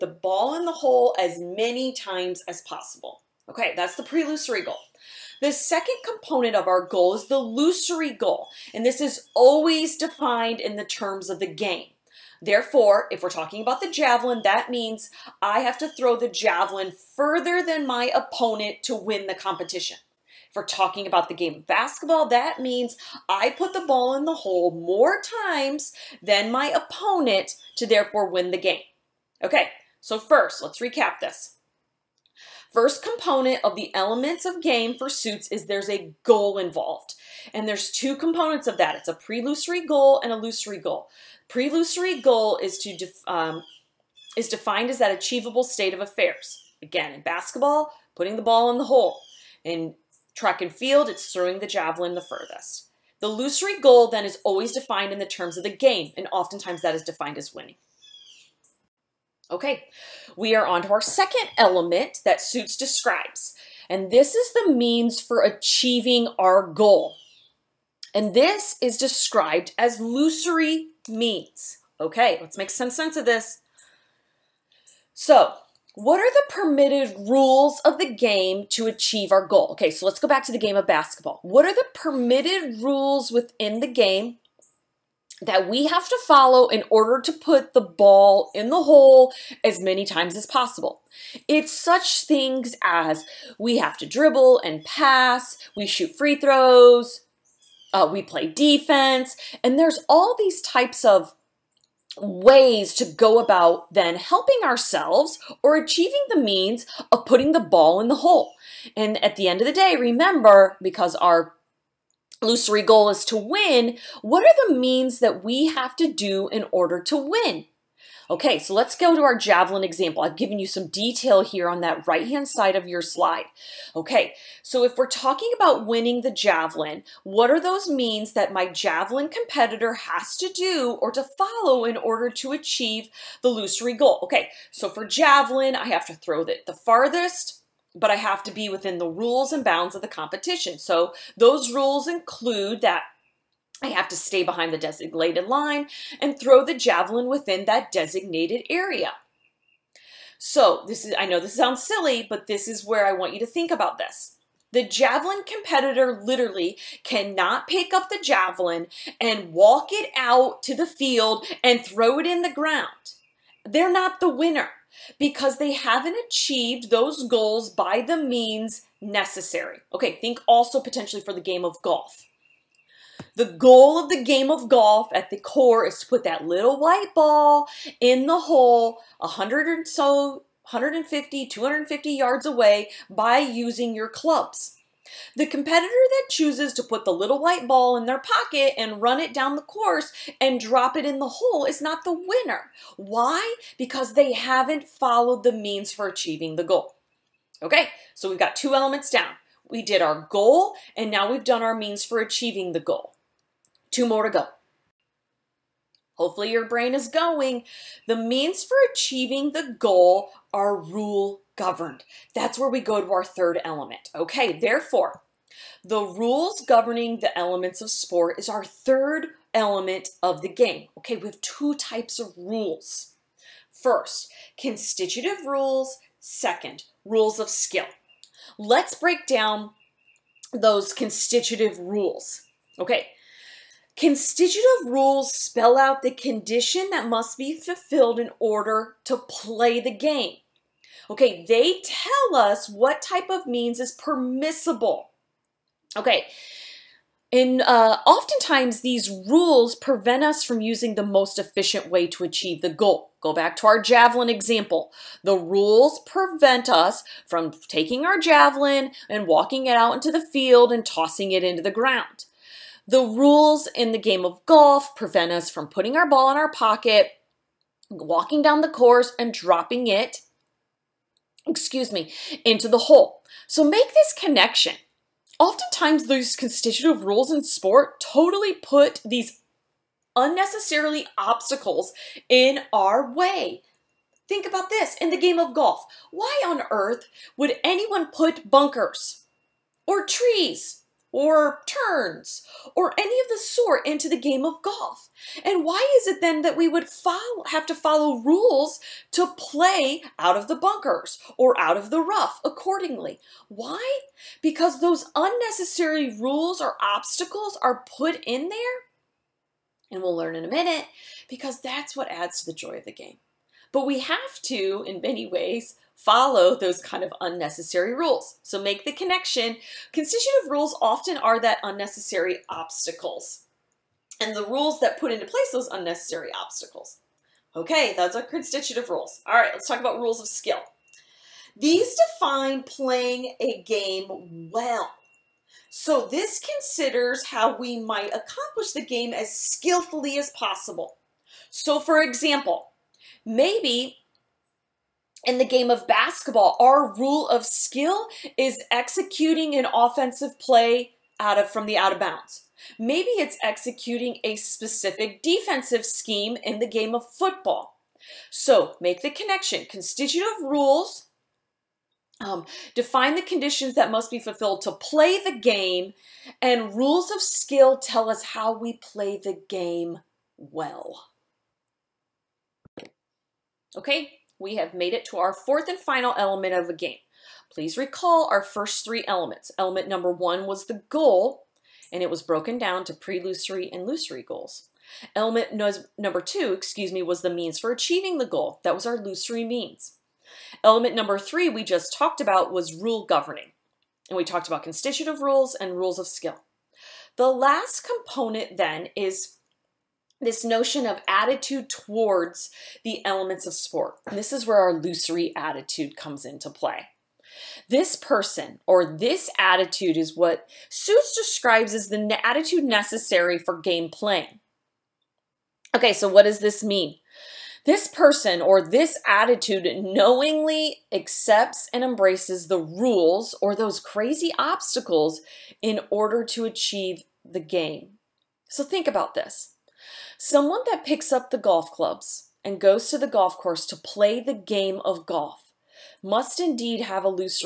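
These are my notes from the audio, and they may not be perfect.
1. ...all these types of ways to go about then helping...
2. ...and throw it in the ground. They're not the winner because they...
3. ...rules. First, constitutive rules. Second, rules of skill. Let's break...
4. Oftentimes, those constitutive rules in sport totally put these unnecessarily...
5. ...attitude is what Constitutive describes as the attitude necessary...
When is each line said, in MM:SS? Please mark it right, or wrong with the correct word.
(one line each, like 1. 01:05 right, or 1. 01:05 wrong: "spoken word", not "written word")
1. 01:40 right
2. 02:41 right
3. 03:42 right
4. 04:35 right
5. 06:49 wrong: "Suits", not "Constitutive".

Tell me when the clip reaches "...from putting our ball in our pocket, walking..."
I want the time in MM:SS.
04:25.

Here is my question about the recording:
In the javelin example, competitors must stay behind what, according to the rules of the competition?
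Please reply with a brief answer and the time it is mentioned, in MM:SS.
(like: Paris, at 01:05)
the designated line, at 02:24.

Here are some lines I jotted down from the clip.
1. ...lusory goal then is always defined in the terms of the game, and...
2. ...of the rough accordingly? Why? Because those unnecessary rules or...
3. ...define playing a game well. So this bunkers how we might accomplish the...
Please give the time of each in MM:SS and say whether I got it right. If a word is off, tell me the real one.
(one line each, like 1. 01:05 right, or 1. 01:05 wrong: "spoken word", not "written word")
1. 00:53 right
2. 05:01 right
3. 05:32 wrong: "considers", not "bunkers".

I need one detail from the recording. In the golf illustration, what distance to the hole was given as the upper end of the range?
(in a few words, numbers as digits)
250 yards.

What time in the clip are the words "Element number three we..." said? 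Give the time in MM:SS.
06:30.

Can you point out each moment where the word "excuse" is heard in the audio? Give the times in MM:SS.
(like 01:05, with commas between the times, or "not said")
04:31, 06:26.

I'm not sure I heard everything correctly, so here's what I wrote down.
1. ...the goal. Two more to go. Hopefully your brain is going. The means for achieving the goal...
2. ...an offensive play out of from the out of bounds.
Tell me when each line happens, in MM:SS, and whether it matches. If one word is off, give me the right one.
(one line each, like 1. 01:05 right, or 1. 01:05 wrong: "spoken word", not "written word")
1. 03:22 right
2. 05:49 right.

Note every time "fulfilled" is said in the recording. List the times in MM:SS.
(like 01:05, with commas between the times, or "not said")
03:57, 06:04.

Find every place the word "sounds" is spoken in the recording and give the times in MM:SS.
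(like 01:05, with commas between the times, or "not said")
02:31.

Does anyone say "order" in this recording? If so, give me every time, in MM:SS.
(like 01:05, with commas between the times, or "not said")
01:26, 01:56, 02:11, 03:58, 07:05.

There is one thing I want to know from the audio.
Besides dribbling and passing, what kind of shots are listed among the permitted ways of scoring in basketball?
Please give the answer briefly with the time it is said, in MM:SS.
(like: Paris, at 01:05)
free throws, at 01:36.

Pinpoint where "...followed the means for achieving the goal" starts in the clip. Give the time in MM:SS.
03:14.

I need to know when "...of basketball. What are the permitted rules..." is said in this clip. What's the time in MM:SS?
01:20.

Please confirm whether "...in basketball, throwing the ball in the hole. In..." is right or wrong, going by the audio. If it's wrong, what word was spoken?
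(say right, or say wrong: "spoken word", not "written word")
wrong: "putting", not "throwing".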